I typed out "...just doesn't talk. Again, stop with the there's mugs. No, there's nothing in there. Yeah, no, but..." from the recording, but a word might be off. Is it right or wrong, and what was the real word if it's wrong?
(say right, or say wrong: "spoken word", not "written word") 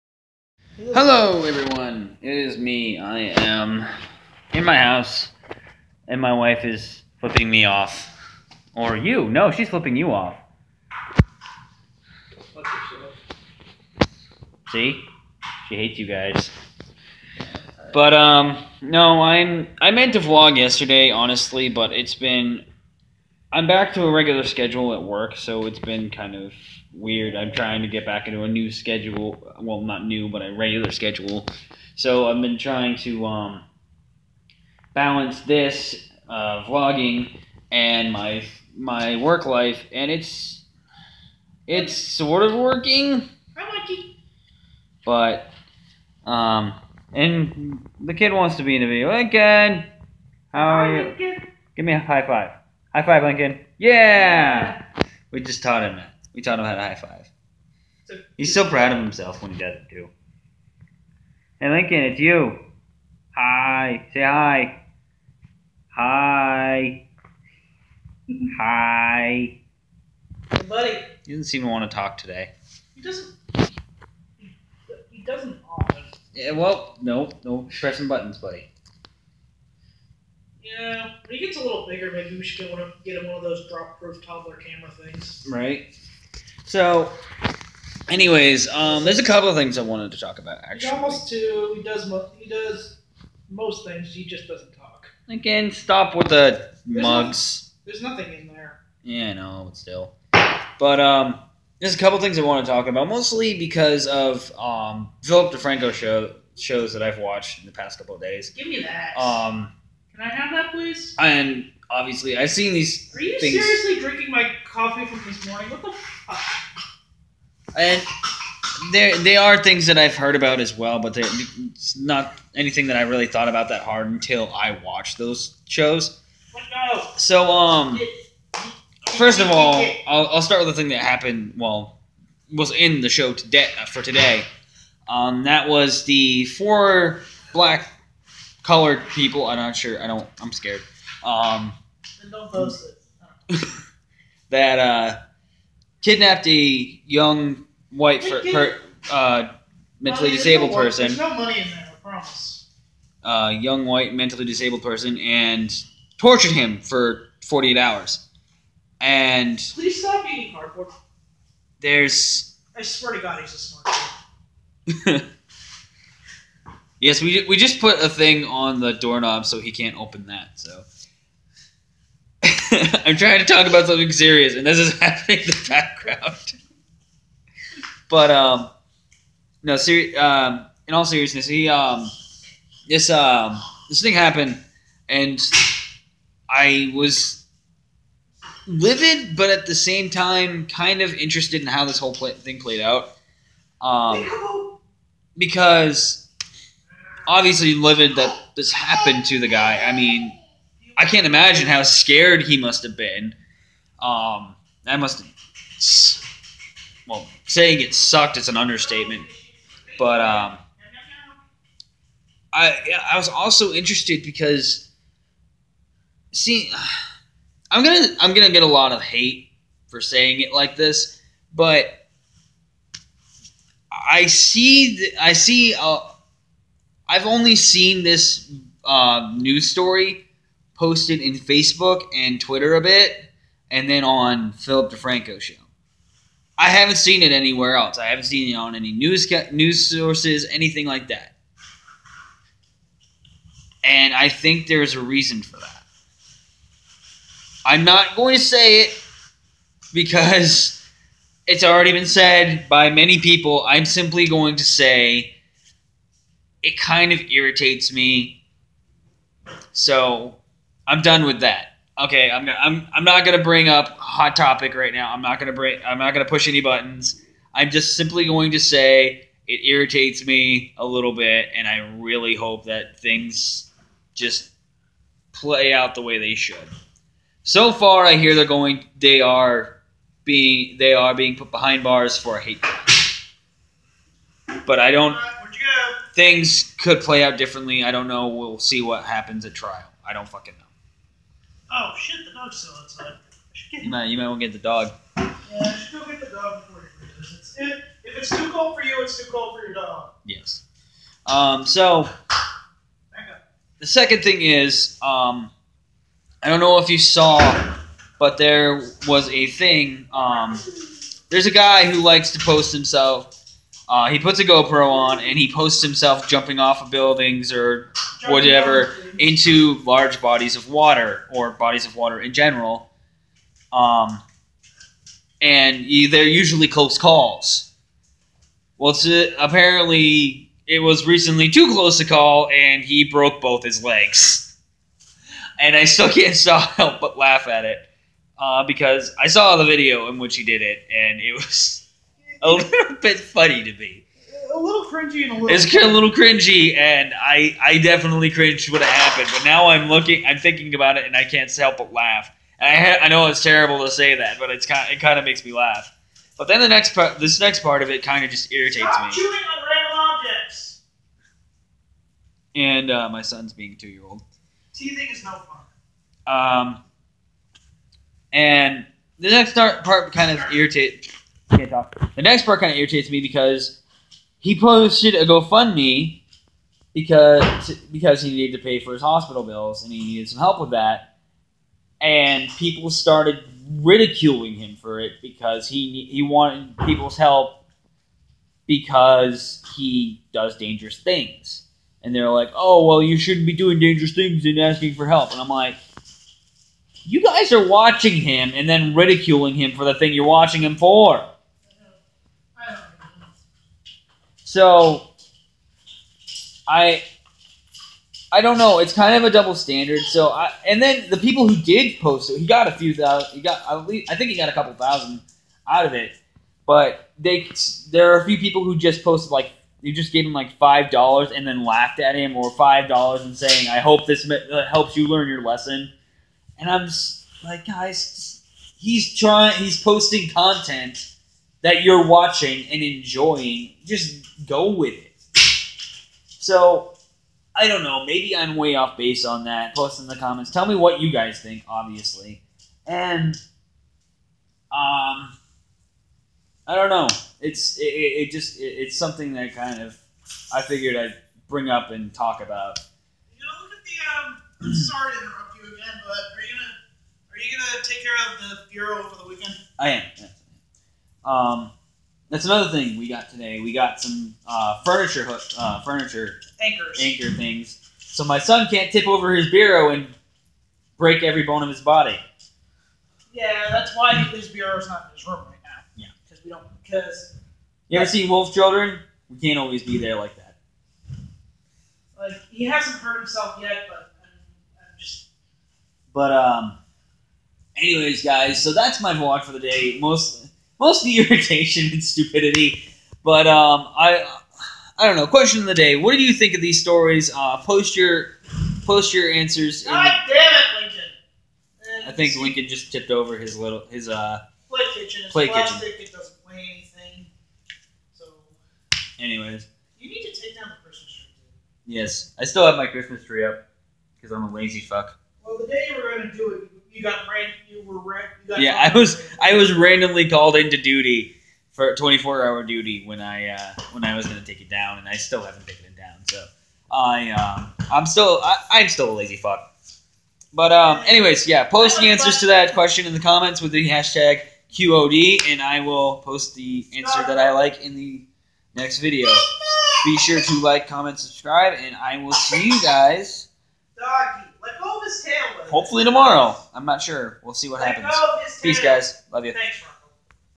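right.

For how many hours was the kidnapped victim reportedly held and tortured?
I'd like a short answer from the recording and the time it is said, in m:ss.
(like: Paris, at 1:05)
48, at 2:37.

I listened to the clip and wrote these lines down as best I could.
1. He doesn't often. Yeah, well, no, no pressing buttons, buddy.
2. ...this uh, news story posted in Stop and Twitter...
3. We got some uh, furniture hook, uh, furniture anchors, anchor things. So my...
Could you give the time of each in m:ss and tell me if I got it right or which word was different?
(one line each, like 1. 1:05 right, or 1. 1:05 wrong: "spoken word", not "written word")
1. 1:15 right
2. 3:48 wrong: "Facebook", not "Stop"
3. 7:43 right.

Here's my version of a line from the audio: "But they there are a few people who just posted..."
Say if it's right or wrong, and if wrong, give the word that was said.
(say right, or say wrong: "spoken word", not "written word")
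right.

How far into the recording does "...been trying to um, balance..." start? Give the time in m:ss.
0:32.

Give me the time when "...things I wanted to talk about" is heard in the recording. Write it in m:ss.
1:29.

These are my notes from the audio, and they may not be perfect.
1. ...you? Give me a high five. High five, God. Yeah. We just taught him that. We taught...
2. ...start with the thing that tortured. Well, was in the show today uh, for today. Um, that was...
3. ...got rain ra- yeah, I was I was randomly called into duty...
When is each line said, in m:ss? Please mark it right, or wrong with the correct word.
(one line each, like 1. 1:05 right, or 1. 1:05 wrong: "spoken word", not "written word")
1. 0:51 wrong: "Lincoln", not "God"
2. 2:10 wrong: "happened", not "tortured"
3. 8:37 right.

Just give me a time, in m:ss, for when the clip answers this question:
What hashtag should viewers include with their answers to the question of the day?
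8:54.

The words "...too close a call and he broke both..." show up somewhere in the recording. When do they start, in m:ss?
5:31.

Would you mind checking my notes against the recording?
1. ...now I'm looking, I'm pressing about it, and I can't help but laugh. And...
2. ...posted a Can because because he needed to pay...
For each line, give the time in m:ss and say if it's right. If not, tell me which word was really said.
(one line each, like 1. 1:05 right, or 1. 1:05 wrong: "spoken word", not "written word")
1. 5:49 wrong: "thinking", not "pressing"
2. 6:14 wrong: "GoFundMe", not "Can".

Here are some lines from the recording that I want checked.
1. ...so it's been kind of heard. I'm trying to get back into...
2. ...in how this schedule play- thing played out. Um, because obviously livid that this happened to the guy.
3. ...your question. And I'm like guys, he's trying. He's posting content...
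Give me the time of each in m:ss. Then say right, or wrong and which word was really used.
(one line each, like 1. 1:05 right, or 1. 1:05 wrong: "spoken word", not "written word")
1. 0:25 wrong: "weird", not "heard"
2. 3:11 wrong: "whole", not "schedule"
3. 7:05 wrong: "lesson", not "question".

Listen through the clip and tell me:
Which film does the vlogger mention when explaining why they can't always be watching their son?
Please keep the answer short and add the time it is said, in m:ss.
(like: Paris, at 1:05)
Wolf Children, at 7:58.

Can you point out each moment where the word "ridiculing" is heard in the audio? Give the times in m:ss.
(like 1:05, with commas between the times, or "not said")
6:23, 6:38.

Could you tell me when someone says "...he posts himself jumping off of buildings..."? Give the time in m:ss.
5:15.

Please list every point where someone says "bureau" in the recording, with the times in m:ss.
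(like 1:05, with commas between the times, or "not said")
7:38, 7:49, 7:54.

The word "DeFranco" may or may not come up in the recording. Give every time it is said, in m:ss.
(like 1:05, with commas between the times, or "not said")
1:45, 3:54.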